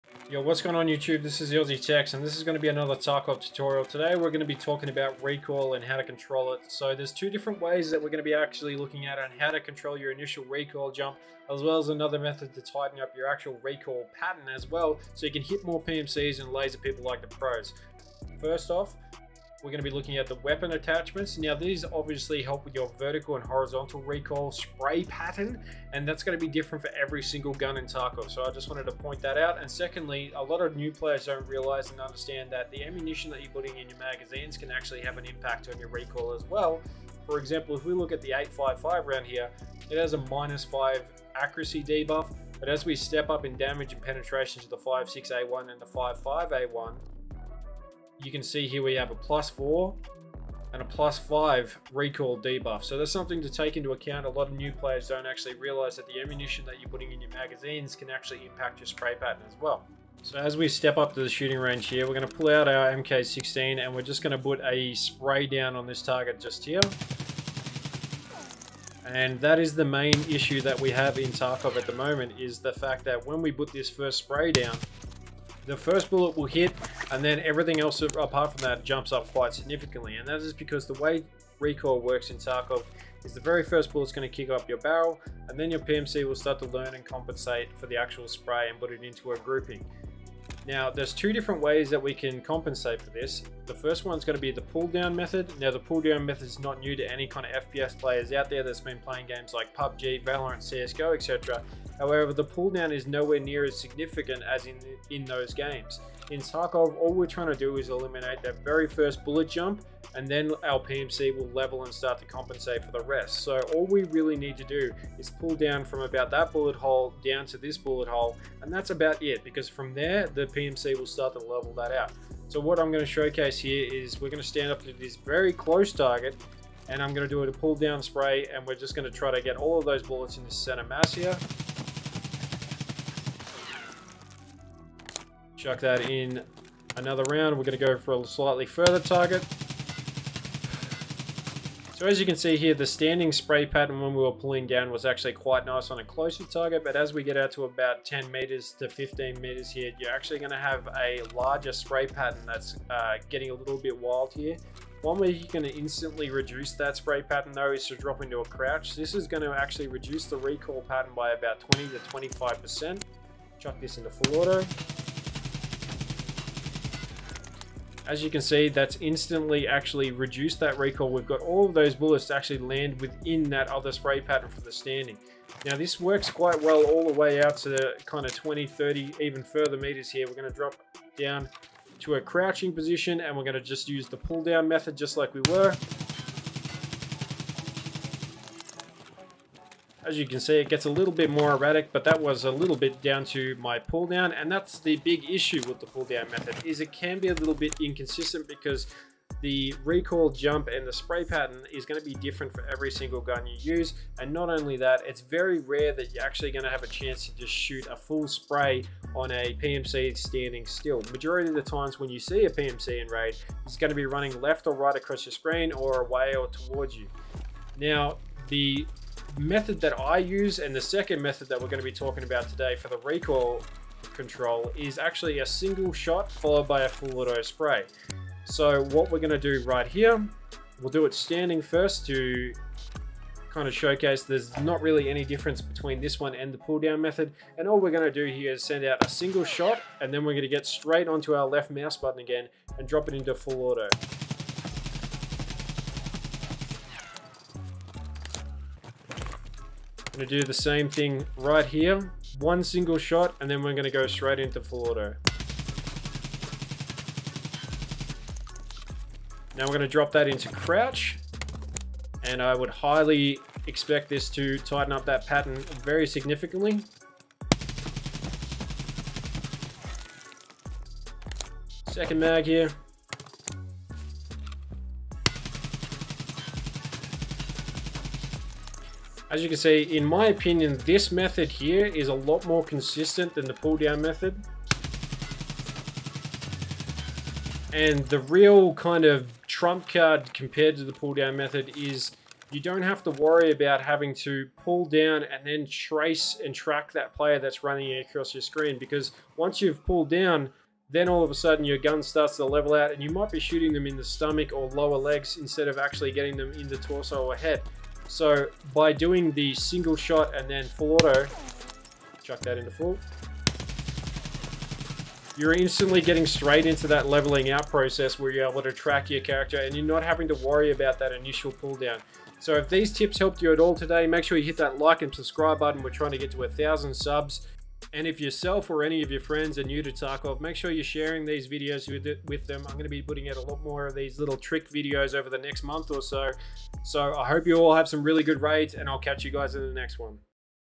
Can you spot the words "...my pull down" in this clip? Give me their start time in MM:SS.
03:13.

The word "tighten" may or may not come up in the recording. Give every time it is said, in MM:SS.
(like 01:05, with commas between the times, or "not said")
00:12, 04:24.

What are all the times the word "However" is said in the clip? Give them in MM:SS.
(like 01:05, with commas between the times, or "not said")
01:41.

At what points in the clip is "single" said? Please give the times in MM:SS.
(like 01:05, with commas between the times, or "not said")
00:27, 03:22, 03:45, 03:59, 04:12, 05:09.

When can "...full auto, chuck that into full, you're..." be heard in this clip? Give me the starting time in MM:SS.
05:10.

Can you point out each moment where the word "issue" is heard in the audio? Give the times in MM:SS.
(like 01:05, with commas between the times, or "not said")
01:10, 03:15.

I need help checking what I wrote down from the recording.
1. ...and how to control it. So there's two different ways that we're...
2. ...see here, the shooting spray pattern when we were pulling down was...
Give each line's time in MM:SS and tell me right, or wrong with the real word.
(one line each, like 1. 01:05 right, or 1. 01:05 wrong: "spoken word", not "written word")
1. 00:05 right
2. 02:22 wrong: "standing", not "shooting".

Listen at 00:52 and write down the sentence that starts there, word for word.
So that's something to take into account.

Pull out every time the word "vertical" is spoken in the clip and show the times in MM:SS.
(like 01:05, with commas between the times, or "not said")
00:22.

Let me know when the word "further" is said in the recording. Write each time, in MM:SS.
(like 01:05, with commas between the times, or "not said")
02:18, 02:59.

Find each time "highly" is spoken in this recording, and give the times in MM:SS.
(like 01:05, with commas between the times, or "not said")
04:22.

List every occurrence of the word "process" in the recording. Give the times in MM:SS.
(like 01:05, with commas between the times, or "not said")
05:17.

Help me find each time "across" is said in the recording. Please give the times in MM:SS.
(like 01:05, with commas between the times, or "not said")
03:34, 04:57.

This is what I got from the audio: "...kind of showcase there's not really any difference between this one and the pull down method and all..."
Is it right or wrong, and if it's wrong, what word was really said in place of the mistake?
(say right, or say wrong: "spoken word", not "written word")
right.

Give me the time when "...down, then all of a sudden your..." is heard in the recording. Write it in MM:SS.
05:00.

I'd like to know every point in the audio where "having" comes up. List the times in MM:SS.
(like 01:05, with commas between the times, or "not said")
04:53, 05:20.